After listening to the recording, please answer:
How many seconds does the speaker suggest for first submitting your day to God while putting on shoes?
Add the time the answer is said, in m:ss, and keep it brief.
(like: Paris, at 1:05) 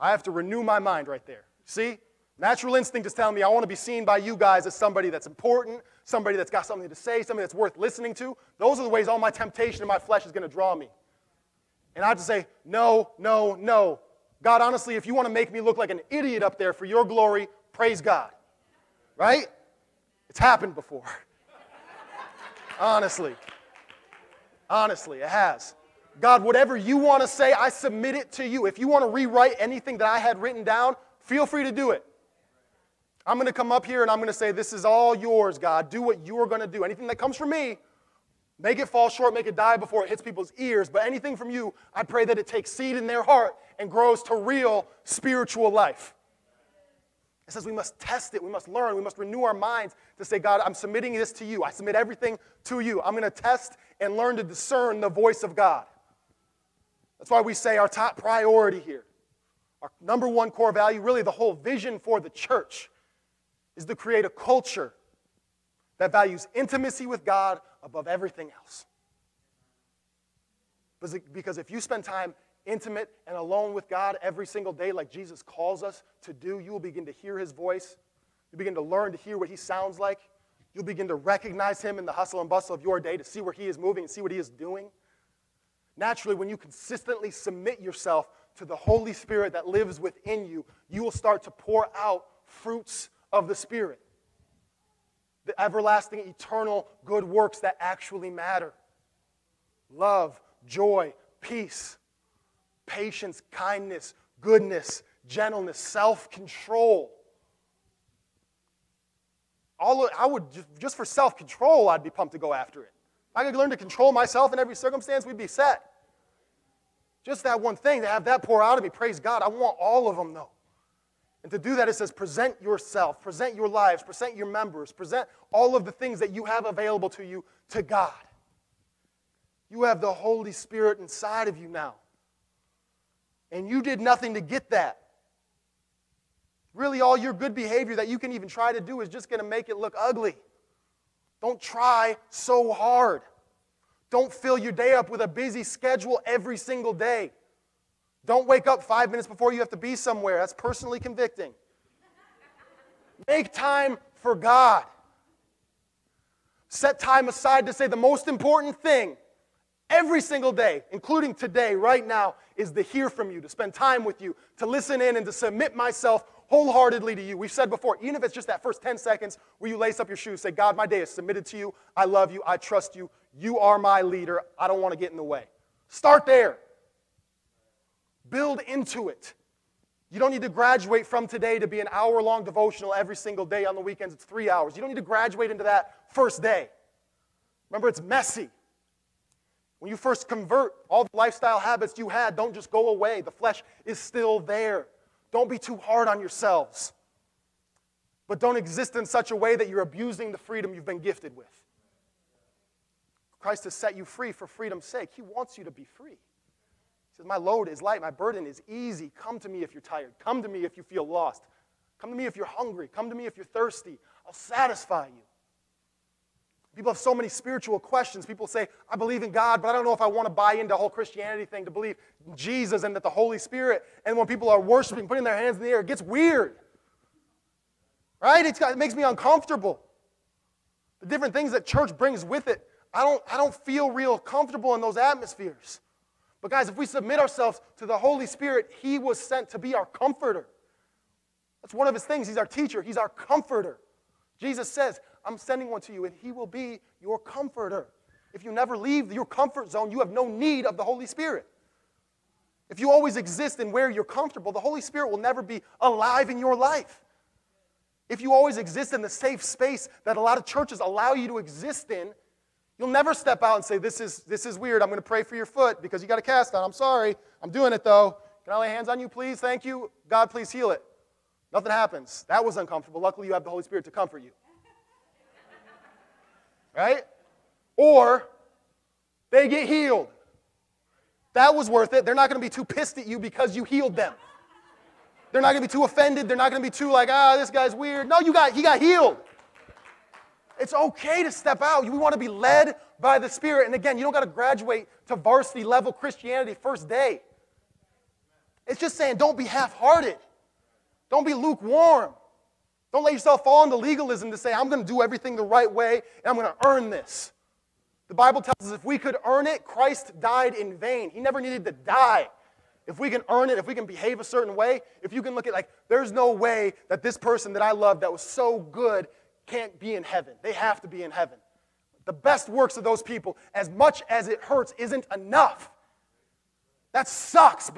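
10, at 2:48.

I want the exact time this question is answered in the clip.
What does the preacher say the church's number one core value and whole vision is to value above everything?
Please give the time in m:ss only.
1:06.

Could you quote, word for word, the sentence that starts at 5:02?
Don't let yourself fall into legalism to say, I'm going to do everything the right way and I'm going to earn this.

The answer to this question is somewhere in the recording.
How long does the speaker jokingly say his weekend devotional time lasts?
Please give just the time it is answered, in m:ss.
3:04.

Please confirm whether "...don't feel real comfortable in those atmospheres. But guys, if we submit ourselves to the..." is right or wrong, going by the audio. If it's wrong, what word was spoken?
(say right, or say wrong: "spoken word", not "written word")
right.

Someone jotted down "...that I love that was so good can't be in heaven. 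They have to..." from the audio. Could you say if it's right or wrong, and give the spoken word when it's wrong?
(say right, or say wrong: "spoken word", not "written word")
right.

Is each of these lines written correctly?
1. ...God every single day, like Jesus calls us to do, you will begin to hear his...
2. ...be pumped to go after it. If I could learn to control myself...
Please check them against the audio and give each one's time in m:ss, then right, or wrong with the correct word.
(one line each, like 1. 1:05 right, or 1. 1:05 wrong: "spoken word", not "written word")
1. 1:13 right
2. 1:52 right.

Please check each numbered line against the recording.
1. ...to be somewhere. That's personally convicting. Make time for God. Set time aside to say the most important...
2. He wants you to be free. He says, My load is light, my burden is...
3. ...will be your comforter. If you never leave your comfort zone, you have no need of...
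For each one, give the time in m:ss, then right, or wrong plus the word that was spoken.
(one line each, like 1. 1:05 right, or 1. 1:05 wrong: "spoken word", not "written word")
1. 2:29 right
2. 3:25 right
3. 4:06 right.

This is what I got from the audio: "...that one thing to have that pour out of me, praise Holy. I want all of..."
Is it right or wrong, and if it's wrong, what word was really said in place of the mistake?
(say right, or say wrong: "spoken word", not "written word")
wrong: "God", not "Holy".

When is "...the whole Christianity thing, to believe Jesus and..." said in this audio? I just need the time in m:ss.
3:40.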